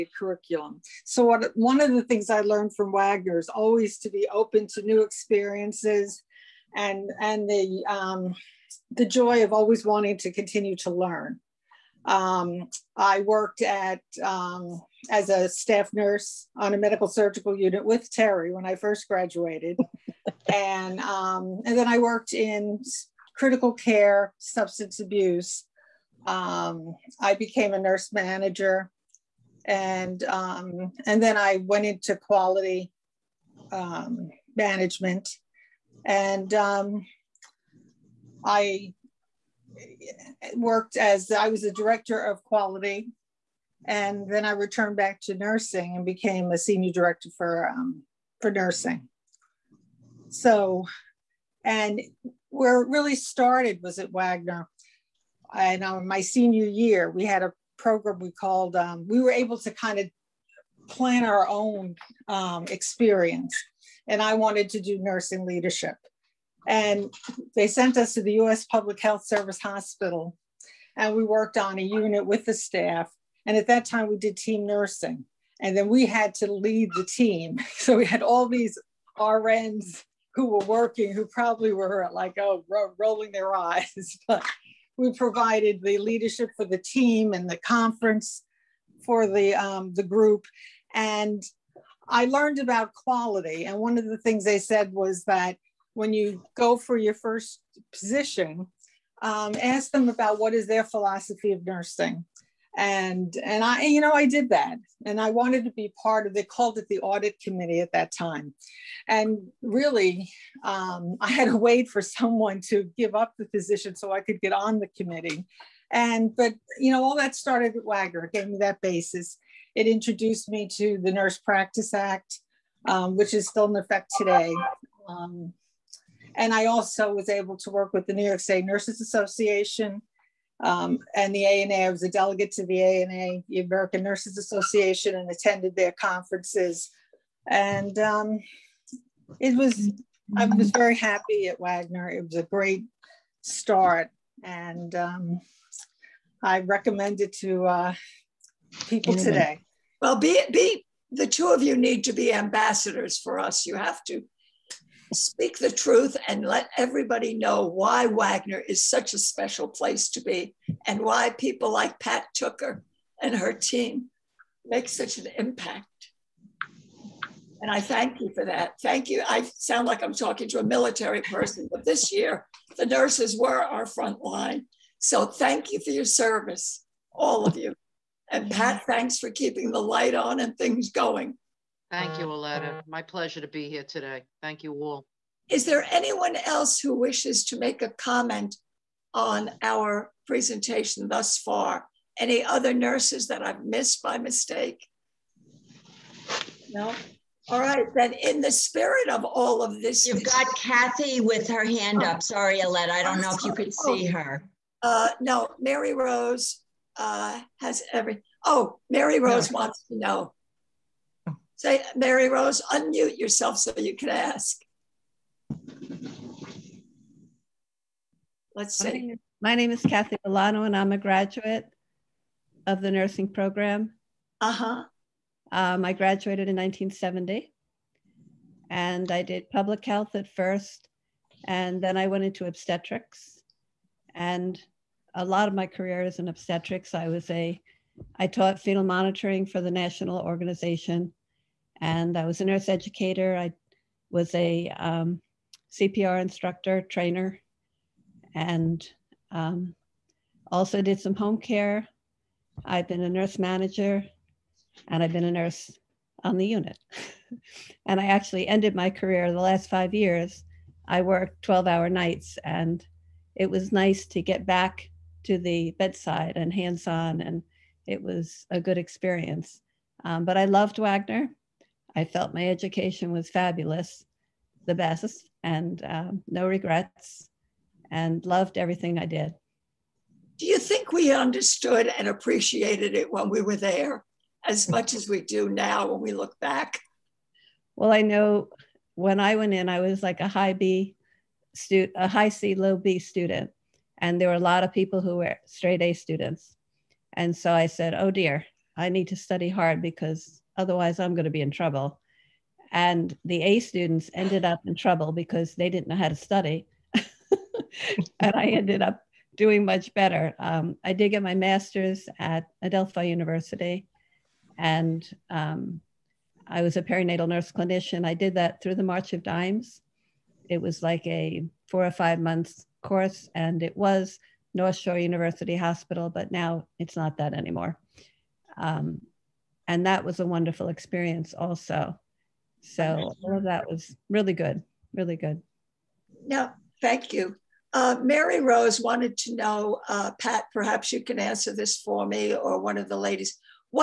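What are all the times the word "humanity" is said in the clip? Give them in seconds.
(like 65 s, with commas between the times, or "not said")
not said.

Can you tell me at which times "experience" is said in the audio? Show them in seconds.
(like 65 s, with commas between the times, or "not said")
5 s, 62 s, 268 s, 330 s.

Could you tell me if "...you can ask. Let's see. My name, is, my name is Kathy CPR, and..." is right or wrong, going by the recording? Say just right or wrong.
wrong.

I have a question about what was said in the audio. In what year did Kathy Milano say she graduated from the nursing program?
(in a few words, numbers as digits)
1970.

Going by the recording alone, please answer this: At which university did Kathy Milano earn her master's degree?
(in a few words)
Adelphi University.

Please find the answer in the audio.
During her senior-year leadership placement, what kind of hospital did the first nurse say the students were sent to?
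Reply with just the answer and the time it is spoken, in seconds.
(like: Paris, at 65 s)
US Public Health Service Hospital, at 68 s.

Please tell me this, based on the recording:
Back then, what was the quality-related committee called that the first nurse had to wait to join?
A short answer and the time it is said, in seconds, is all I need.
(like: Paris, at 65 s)
audit committee, at 106 s.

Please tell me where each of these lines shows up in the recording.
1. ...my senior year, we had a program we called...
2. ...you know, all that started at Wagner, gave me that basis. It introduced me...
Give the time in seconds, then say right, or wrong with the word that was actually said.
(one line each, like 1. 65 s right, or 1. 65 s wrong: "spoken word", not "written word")
1. 56 s right
2. 116 s right.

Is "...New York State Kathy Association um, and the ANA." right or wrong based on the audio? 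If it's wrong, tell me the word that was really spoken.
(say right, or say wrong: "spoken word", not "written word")
wrong: "Nurses", not "Kathy".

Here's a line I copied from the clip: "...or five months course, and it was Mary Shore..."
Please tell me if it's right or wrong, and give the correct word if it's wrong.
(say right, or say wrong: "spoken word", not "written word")
wrong: "North", not "Mary".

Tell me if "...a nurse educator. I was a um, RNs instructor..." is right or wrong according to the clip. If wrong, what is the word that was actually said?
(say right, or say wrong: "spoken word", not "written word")
wrong: "CPR", not "RNs".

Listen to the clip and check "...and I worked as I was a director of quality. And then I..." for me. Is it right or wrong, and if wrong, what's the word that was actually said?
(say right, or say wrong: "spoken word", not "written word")
right.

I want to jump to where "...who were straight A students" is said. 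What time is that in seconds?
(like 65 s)
295 s.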